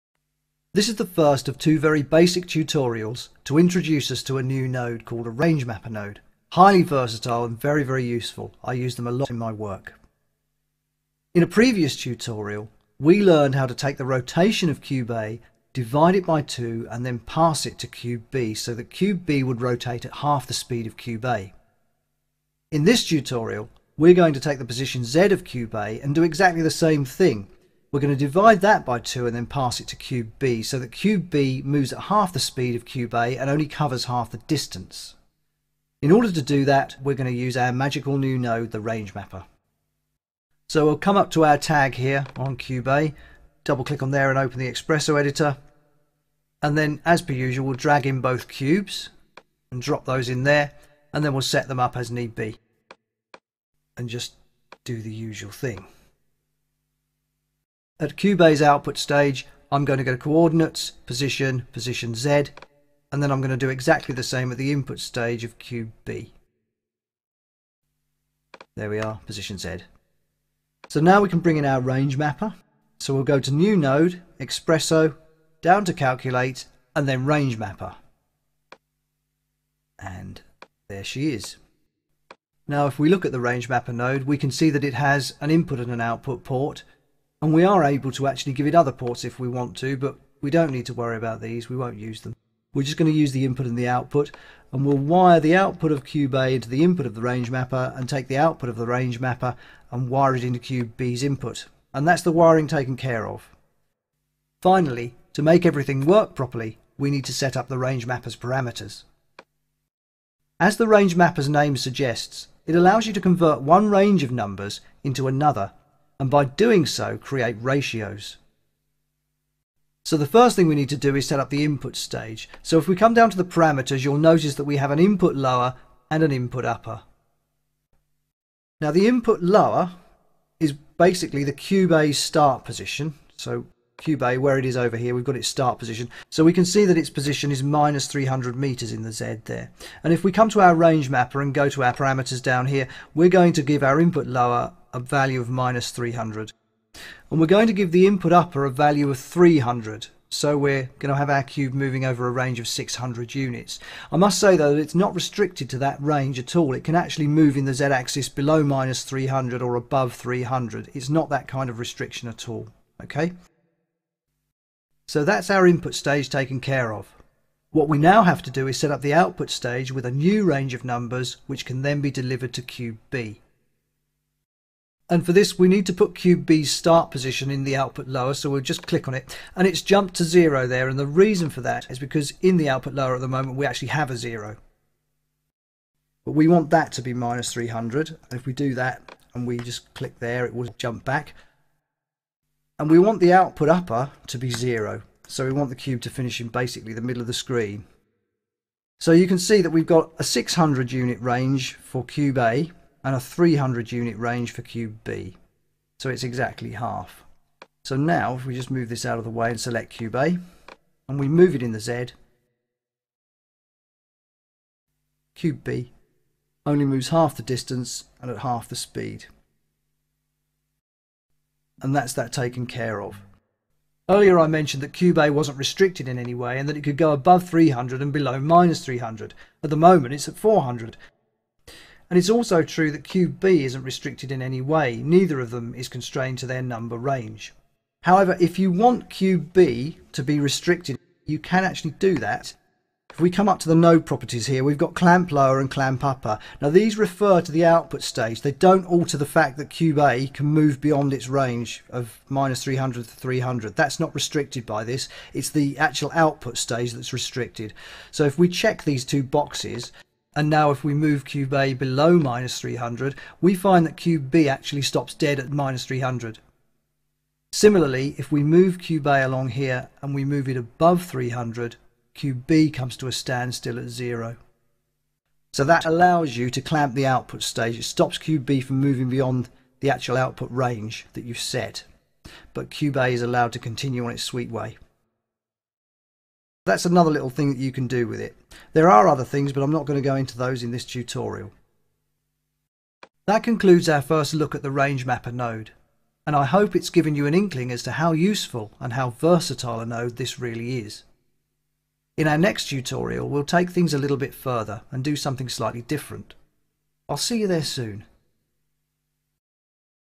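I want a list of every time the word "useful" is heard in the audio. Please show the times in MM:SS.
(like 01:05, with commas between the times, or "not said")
00:08, 04:58.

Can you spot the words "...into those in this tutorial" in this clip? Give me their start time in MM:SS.
04:50.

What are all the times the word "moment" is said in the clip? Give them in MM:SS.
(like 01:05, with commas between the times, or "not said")
03:03, 03:49.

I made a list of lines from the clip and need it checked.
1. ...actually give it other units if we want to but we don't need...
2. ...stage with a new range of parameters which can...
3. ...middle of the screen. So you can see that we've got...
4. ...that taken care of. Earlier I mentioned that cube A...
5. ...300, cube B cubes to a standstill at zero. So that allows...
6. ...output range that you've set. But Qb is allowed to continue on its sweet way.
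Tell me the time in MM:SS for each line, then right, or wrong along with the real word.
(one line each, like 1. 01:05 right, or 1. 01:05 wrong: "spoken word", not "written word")
1. 01:28 wrong: "ports", not "units"
2. 02:49 wrong: "numbers", not "parameters"
3. 03:17 right
4. 03:42 right
5. 04:31 wrong: "comes", not "cubes"
6. 04:40 right.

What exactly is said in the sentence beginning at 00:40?
So we'll come up to our tag here on cube a, double click on there and open the Xpresso editor.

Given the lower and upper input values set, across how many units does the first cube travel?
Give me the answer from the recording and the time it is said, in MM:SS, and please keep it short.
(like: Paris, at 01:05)
600, at 02:32.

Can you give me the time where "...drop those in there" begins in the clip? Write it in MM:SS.
00:49.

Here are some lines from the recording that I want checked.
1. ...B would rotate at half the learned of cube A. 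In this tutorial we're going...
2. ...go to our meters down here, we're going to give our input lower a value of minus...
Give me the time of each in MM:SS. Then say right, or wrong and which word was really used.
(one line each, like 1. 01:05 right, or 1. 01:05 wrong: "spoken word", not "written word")
1. 00:19 wrong: "speed", not "learned"
2. 02:21 wrong: "parameters", not "meters".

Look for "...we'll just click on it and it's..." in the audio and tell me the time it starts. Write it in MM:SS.
02:58.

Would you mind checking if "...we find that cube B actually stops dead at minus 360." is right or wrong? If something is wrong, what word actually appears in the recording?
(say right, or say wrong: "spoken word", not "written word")
wrong: "300", not "360".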